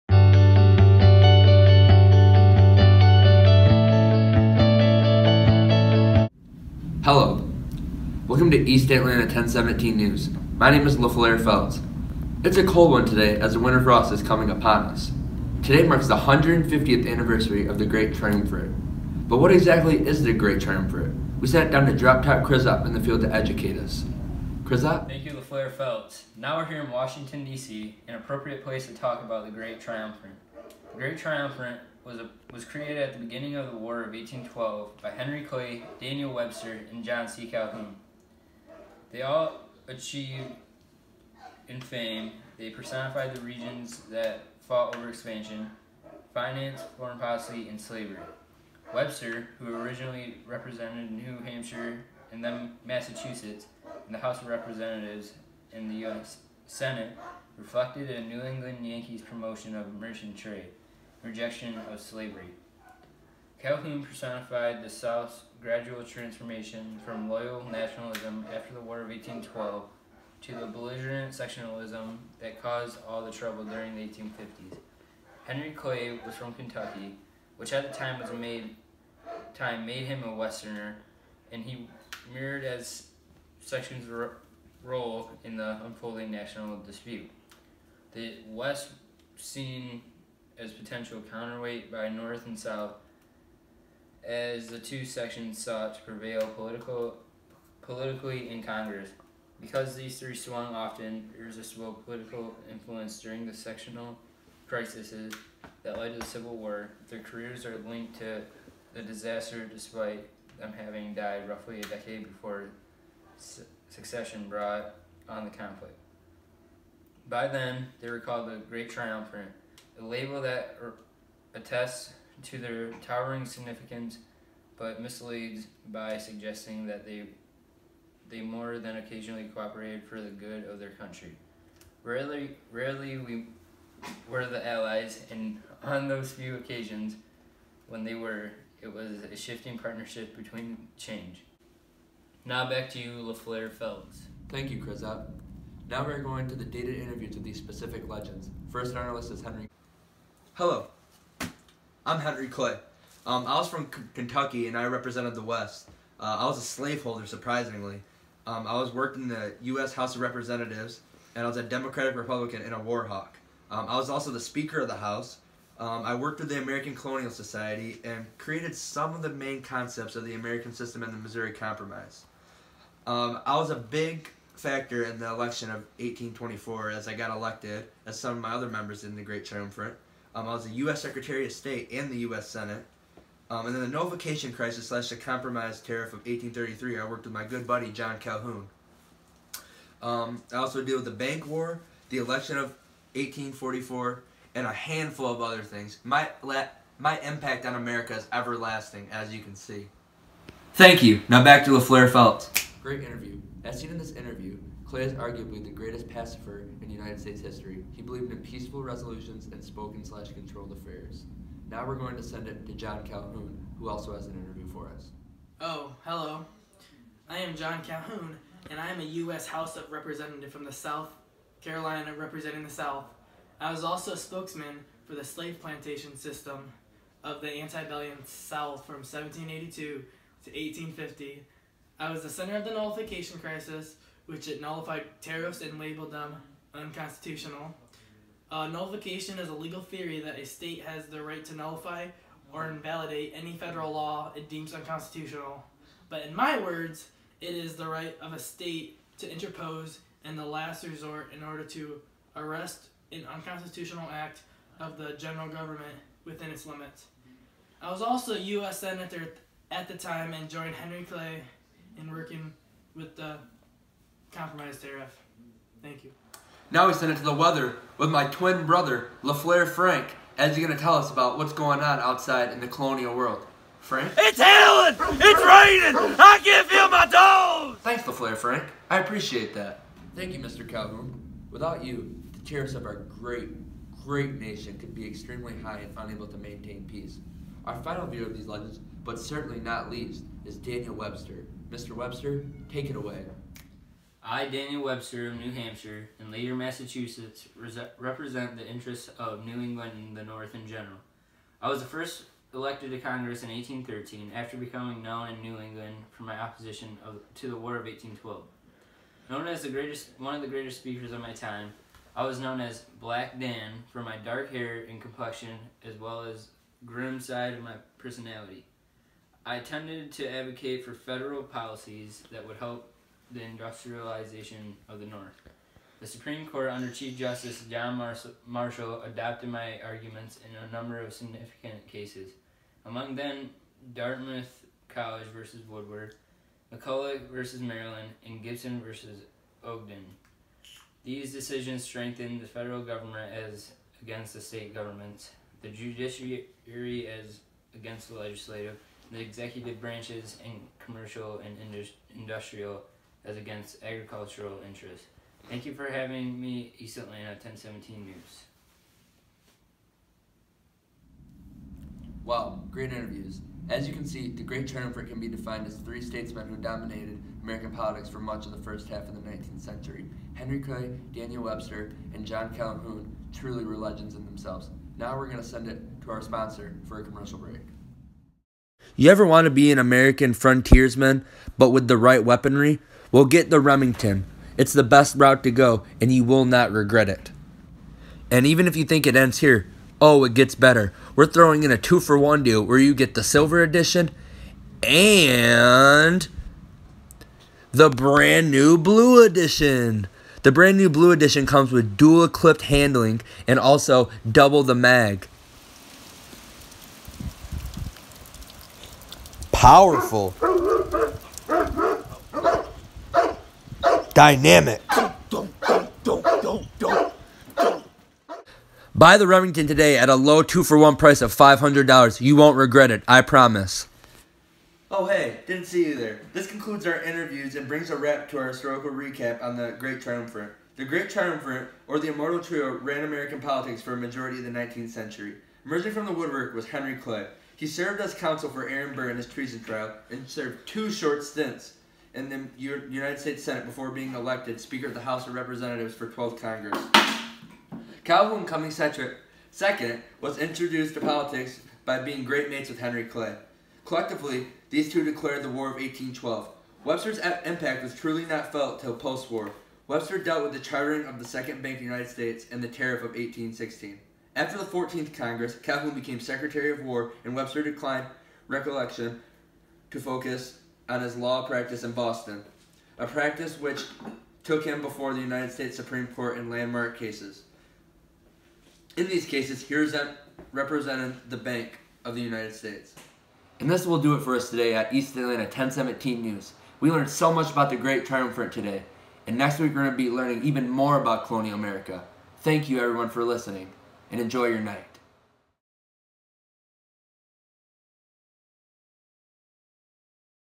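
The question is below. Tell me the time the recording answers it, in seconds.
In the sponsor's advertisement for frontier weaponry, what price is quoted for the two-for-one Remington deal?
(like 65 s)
421 s.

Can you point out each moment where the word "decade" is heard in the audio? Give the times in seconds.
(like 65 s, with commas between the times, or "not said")
111 s.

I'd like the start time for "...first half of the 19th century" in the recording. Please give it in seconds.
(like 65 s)
368 s.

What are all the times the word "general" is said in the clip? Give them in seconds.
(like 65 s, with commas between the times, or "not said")
255 s, 300 s.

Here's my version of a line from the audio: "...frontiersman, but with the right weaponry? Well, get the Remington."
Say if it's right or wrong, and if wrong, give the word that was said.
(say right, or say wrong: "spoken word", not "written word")
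right.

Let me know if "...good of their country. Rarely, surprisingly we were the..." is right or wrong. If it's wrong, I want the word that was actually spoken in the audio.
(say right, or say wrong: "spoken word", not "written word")
wrong: "rarely", not "surprisingly".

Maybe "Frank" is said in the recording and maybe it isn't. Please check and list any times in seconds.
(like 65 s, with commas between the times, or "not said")
269 s, 273 s, 278 s.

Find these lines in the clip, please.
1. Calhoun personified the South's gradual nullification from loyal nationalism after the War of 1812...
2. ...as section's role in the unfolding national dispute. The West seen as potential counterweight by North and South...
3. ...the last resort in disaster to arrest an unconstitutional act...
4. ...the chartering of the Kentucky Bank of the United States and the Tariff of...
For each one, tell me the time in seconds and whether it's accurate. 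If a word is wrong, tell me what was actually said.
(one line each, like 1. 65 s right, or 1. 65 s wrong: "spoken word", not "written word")
1. 63 s wrong: "transformation", not "nullification"
2. 82 s right
3. 250 s wrong: "order", not "disaster"
4. 460 s wrong: "Second", not "Kentucky".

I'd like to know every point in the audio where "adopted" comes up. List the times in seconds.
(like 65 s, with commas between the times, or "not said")
329 s.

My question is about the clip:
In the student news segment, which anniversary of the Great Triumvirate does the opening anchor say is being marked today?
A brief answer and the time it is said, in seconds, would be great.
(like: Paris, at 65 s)
150th, at 16 s.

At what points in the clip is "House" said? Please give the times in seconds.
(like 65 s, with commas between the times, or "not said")
54 s, 159 s, 164 s, 219 s, 445 s.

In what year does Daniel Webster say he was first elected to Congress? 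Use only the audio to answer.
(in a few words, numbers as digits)
1813.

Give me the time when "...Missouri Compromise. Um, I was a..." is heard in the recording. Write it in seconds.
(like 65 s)
171 s.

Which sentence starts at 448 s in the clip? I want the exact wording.
Calhoun Cummings second was introduced to politics by being great mates with Henry Clay.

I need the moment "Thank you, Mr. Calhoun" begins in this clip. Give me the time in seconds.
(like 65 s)
280 s.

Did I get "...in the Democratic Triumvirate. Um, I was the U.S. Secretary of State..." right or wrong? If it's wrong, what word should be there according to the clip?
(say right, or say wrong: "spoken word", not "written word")
wrong: "Great", not "Democratic".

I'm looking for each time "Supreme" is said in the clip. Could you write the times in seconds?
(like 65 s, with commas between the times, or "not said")
326 s, 475 s.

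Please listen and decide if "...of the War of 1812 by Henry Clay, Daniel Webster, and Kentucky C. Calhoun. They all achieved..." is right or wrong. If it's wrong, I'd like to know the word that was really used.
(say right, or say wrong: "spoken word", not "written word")
wrong: "John", not "Kentucky".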